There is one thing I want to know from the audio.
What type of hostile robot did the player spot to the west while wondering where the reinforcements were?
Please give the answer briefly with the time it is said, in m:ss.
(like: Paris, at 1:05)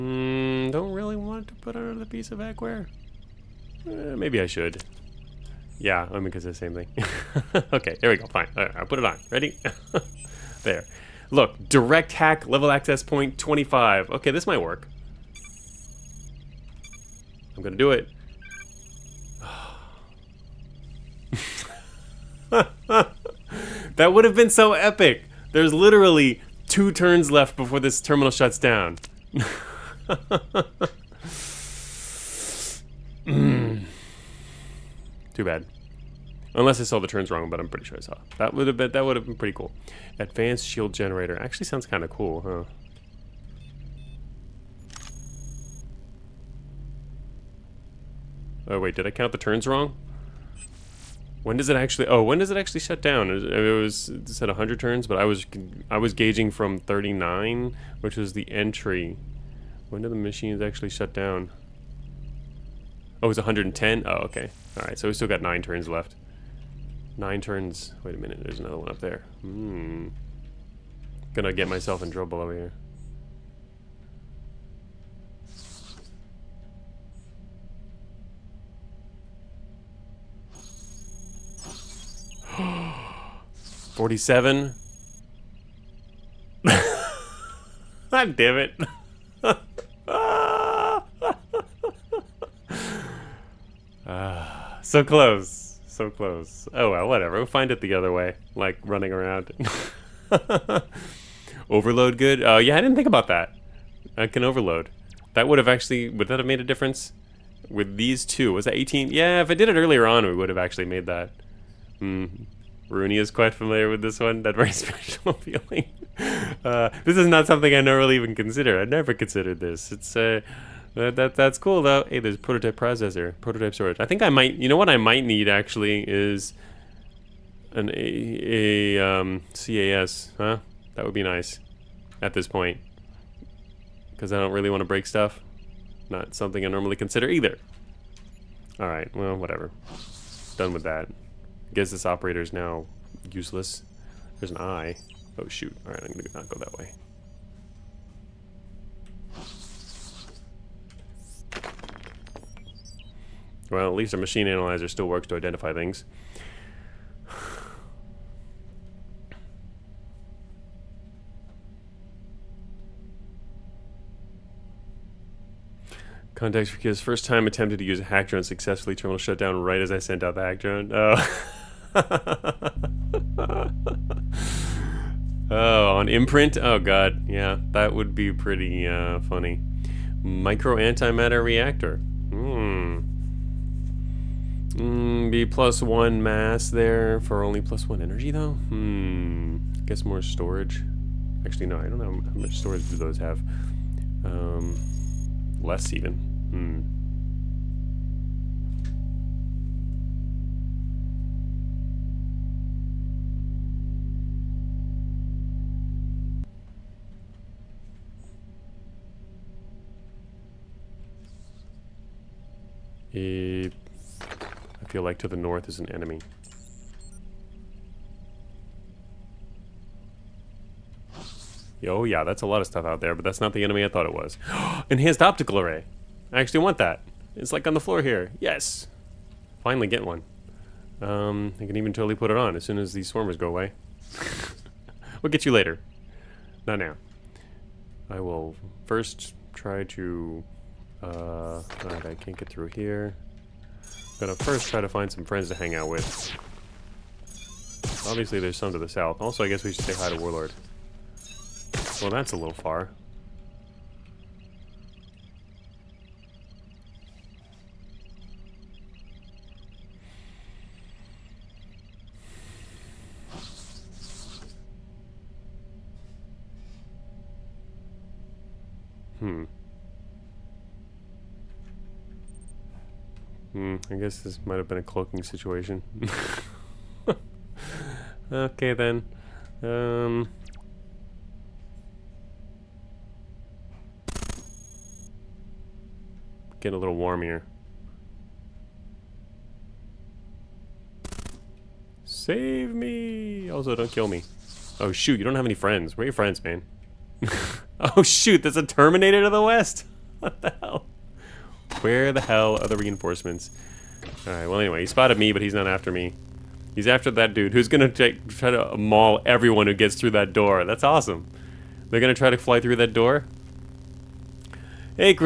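Terminator, at 4:58.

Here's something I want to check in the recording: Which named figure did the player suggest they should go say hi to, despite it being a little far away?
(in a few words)
Warlord.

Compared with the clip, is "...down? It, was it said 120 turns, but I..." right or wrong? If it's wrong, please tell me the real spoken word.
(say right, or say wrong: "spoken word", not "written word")
wrong: "100", not "120".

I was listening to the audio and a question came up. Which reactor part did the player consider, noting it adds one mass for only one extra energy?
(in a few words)
Micro antimatter reactor.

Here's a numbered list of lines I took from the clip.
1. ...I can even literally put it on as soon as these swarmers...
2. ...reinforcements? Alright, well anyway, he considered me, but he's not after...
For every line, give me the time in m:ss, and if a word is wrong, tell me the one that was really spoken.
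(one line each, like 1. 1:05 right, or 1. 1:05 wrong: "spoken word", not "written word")
1. 3:51 wrong: "totally", not "literally"
2. 5:02 wrong: "spotted", not "considered".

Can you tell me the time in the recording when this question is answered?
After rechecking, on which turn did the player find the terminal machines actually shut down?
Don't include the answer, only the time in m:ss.
1:03.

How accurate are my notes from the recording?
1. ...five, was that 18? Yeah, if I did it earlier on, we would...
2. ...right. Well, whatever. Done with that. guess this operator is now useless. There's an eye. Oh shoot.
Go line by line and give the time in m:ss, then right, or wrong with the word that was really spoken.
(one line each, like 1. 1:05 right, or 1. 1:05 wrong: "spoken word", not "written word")
1. 1:48 wrong: "two", not "five"
2. 2:18 right.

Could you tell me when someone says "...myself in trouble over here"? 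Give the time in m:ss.
1:11.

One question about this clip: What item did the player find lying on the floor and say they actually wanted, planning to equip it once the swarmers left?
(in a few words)
Enhanced optical array.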